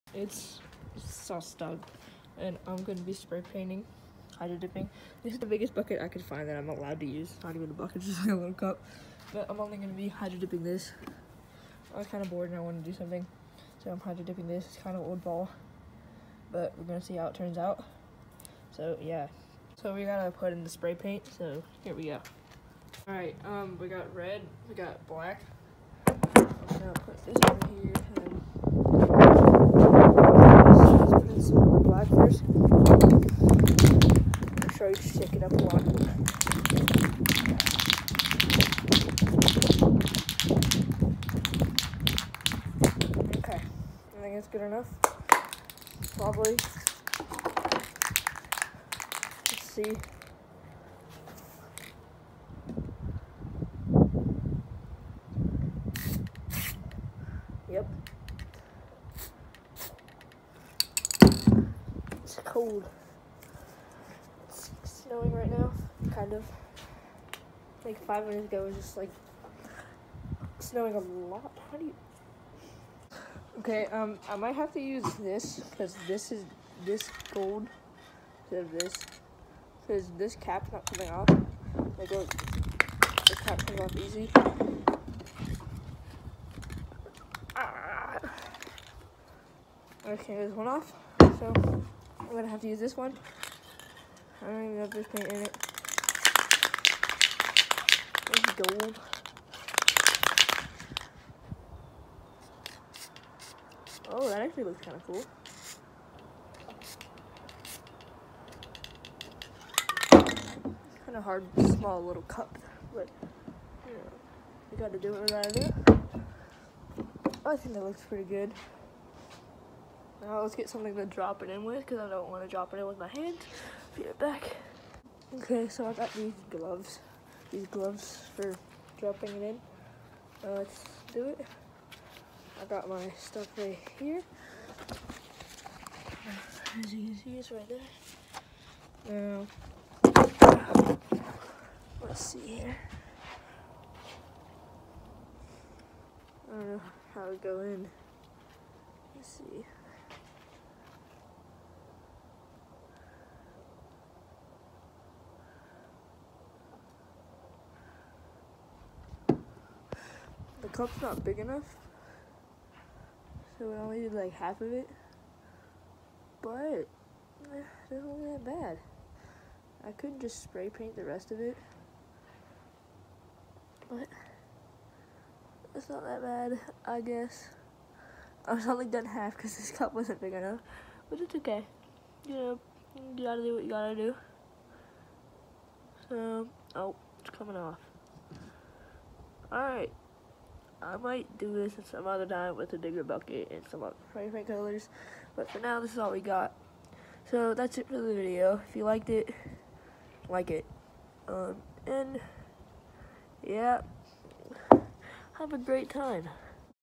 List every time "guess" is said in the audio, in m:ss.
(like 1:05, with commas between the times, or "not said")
2:57.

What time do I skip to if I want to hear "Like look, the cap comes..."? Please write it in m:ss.
1:21.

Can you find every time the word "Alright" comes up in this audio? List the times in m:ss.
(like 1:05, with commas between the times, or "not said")
0:23, 3:09.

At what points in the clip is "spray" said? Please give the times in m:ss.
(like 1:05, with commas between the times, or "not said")
0:03, 0:20, 2:50, 3:14.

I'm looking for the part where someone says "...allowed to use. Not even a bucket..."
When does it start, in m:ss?
0:06.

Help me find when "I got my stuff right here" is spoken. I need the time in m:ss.
2:12.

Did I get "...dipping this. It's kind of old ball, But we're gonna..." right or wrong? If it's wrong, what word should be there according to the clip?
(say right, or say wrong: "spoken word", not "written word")
right.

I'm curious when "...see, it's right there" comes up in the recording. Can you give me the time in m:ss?
2:17.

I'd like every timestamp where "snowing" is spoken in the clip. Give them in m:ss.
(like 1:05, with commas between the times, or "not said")
1:04, 1:10.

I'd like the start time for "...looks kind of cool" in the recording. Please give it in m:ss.
1:44.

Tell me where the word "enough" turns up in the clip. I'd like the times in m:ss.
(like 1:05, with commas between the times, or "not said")
0:44, 2:41, 3:00.